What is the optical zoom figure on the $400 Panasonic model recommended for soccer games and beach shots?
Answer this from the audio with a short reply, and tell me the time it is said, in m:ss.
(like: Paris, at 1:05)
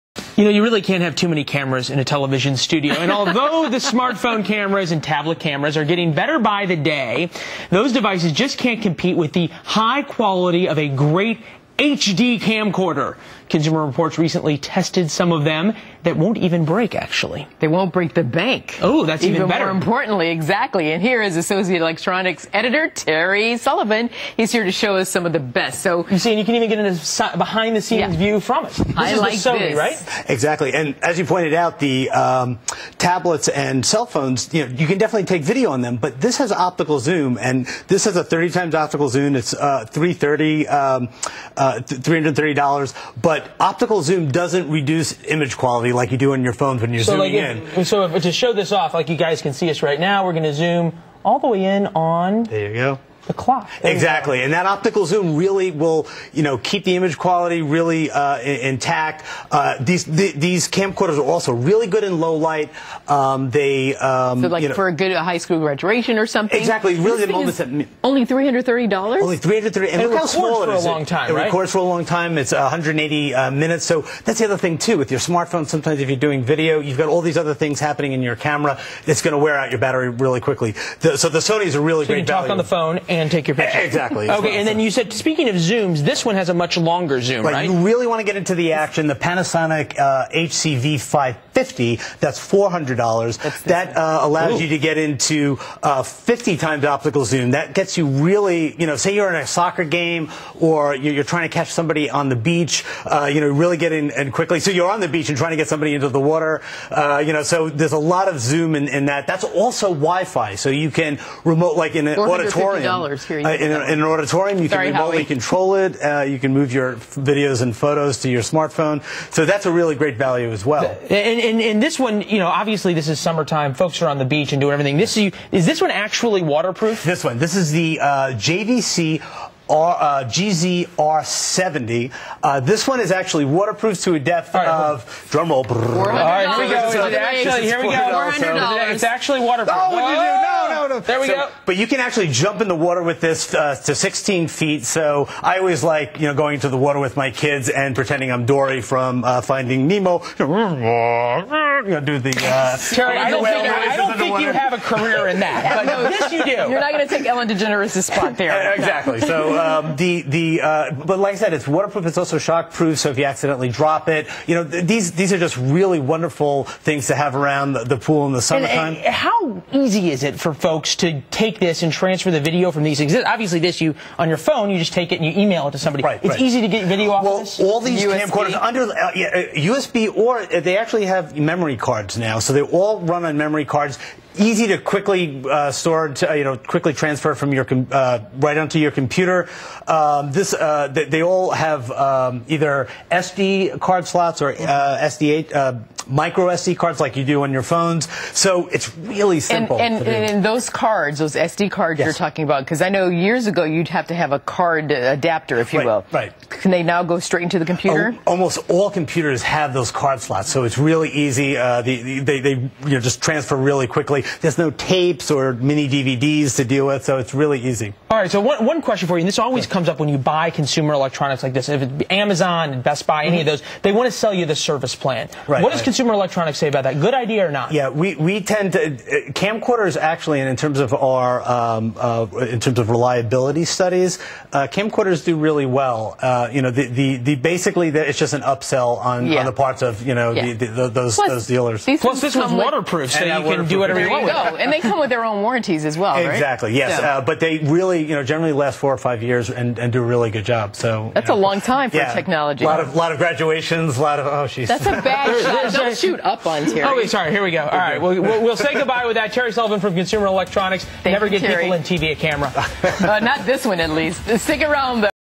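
50 times, at 1:36.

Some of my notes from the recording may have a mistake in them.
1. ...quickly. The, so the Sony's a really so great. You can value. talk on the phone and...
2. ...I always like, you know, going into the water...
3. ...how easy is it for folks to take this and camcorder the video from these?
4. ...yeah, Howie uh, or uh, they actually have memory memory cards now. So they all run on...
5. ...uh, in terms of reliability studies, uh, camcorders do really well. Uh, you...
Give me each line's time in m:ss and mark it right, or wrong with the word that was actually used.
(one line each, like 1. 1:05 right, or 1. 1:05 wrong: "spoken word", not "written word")
1. 1:20 right
2. 2:25 right
3. 2:49 wrong: "transfer", not "camcorder"
4. 2:59 wrong: "USB", not "Howie"
5. 3:51 right.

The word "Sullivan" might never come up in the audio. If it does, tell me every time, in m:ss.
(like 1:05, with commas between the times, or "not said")
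0:23, 4:19.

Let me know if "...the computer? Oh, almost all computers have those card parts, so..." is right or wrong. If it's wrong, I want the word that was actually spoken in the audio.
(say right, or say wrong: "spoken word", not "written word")
wrong: "slots", not "parts".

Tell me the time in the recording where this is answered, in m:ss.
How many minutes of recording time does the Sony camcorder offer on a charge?
1:12.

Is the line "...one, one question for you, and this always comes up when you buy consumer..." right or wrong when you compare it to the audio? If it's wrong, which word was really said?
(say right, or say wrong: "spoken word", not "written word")
right.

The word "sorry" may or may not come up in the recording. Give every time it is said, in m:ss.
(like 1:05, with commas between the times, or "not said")
1:54, 4:17.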